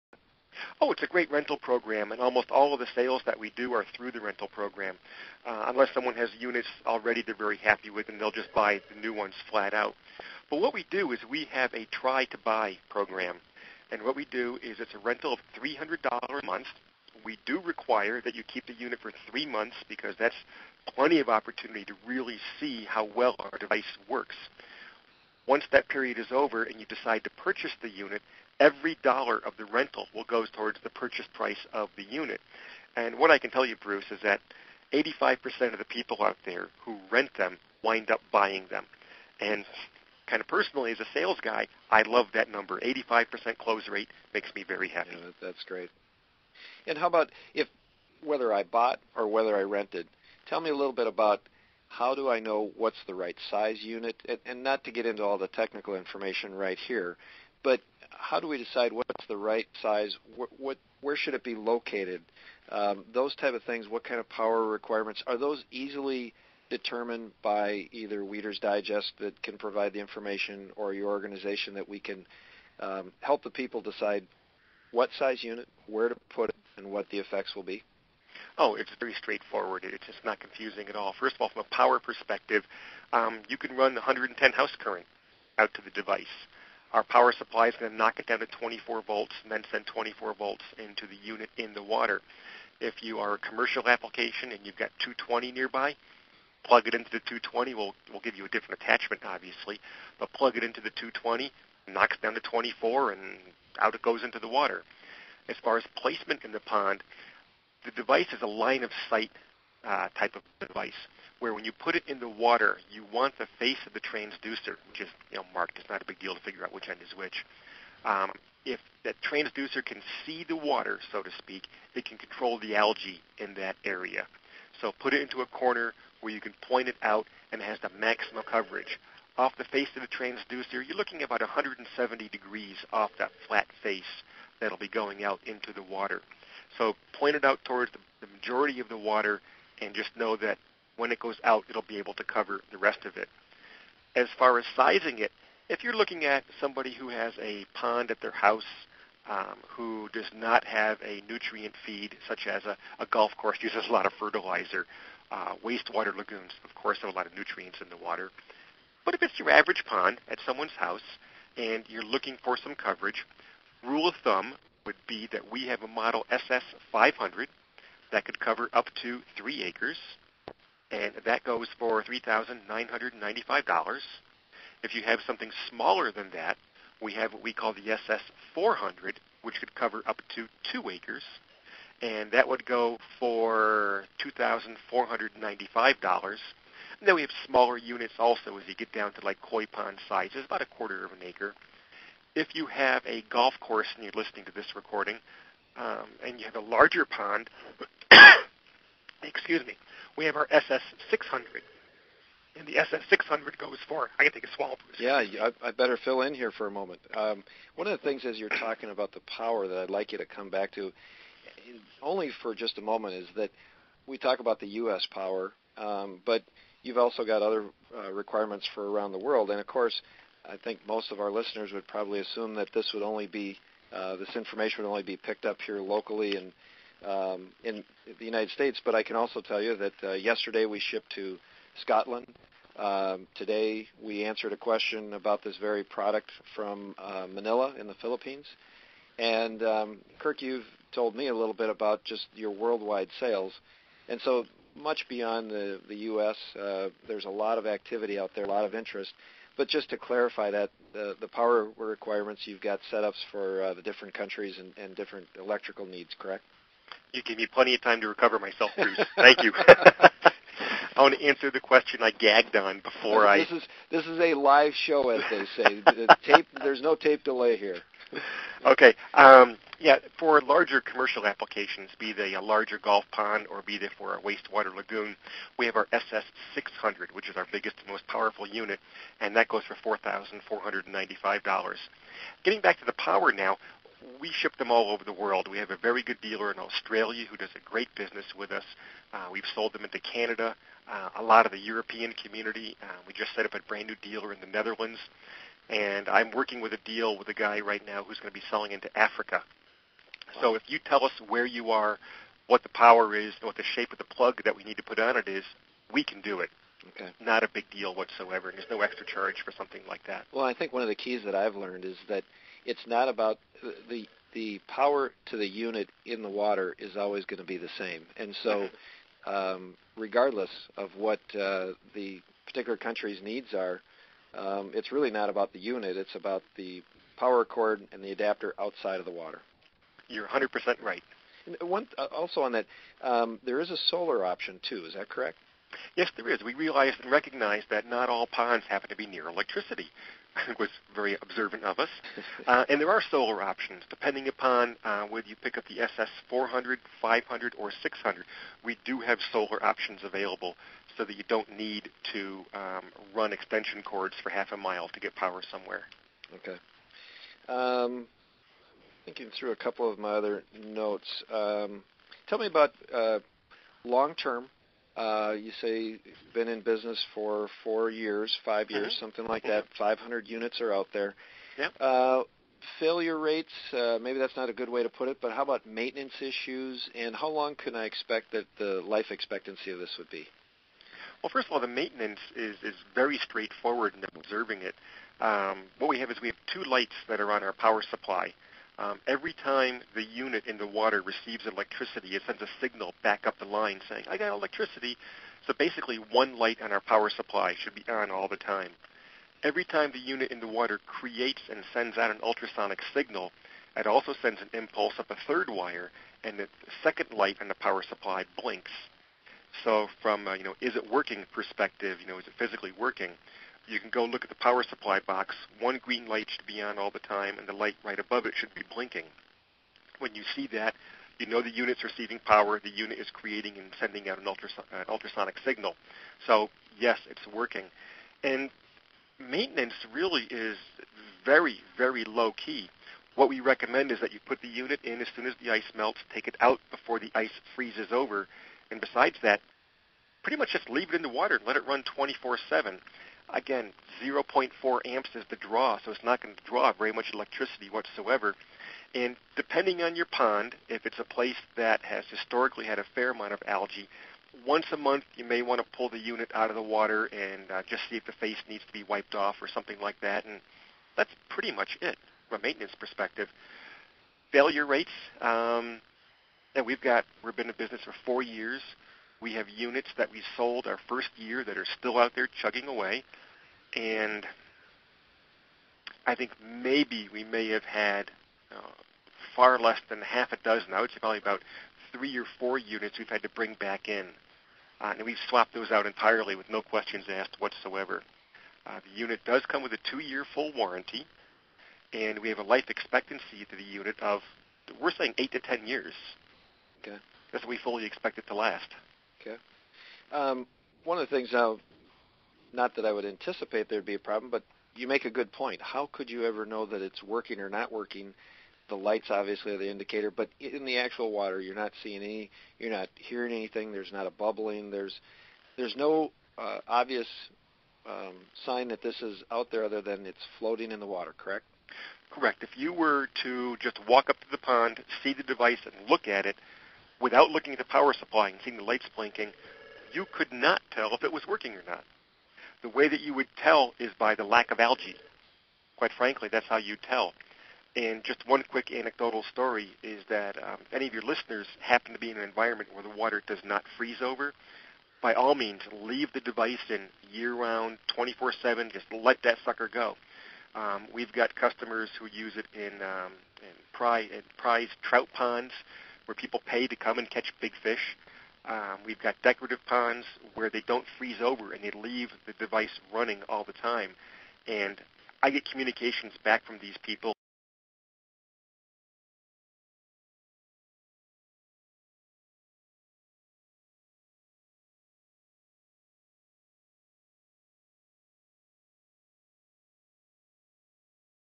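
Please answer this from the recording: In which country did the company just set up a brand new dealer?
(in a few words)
Netherlands.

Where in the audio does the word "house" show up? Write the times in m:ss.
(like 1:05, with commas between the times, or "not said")
1:24, 2:28, 2:40.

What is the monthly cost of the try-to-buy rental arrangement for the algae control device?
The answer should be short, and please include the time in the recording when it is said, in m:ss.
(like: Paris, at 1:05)
$300, at 0:15.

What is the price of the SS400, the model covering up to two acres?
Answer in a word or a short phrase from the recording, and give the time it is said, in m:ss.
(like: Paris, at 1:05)
$2,495, at 3:04.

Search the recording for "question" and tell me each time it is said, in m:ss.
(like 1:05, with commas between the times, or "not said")
3:54, 4:21, 8:06.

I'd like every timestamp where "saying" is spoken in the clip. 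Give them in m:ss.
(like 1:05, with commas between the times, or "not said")
6:33, 8:14.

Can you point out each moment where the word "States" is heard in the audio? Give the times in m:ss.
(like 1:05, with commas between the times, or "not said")
3:48.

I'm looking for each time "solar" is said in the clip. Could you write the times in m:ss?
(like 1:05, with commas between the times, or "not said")
5:33, 5:43, 5:49.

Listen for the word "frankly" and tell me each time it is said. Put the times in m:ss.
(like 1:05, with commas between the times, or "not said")
8:55.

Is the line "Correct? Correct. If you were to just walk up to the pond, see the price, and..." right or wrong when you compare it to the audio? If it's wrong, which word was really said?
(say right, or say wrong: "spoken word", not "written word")
wrong: "device", not "price".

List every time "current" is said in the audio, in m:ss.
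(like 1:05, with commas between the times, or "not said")
1:24.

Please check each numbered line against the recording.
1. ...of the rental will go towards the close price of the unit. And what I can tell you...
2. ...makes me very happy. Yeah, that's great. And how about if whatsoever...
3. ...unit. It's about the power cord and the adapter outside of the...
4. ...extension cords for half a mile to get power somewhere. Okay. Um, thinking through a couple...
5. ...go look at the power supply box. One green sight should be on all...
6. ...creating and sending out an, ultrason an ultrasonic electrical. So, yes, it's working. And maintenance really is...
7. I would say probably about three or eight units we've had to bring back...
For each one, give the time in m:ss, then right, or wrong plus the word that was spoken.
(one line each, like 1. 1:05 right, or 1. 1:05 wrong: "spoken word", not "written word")
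1. 0:29 wrong: "purchase", not "close"
2. 0:44 wrong: "whether", not "whatsoever"
3. 5:25 right
4. 5:53 right
5. 6:53 wrong: "light", not "sight"
6. 7:03 wrong: "signal", not "electrical"
7. 8:00 wrong: "four", not "eight".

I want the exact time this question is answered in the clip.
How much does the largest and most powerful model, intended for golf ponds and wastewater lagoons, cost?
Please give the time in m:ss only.
4:39.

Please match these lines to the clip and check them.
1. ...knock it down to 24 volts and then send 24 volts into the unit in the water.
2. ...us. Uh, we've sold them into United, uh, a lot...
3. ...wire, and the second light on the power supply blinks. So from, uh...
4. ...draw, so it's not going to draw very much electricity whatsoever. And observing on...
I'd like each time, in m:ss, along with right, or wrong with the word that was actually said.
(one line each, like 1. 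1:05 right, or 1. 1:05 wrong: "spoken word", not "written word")
1. 1:27 right
2. 4:48 wrong: "Canada", not "United"
3. 6:45 right
4. 7:25 wrong: "depending", not "observing".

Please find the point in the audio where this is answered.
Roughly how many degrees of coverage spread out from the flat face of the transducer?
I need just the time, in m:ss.
2:11.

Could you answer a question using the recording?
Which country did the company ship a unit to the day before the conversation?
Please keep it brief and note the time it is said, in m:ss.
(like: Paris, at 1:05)
Scotland, at 3:51.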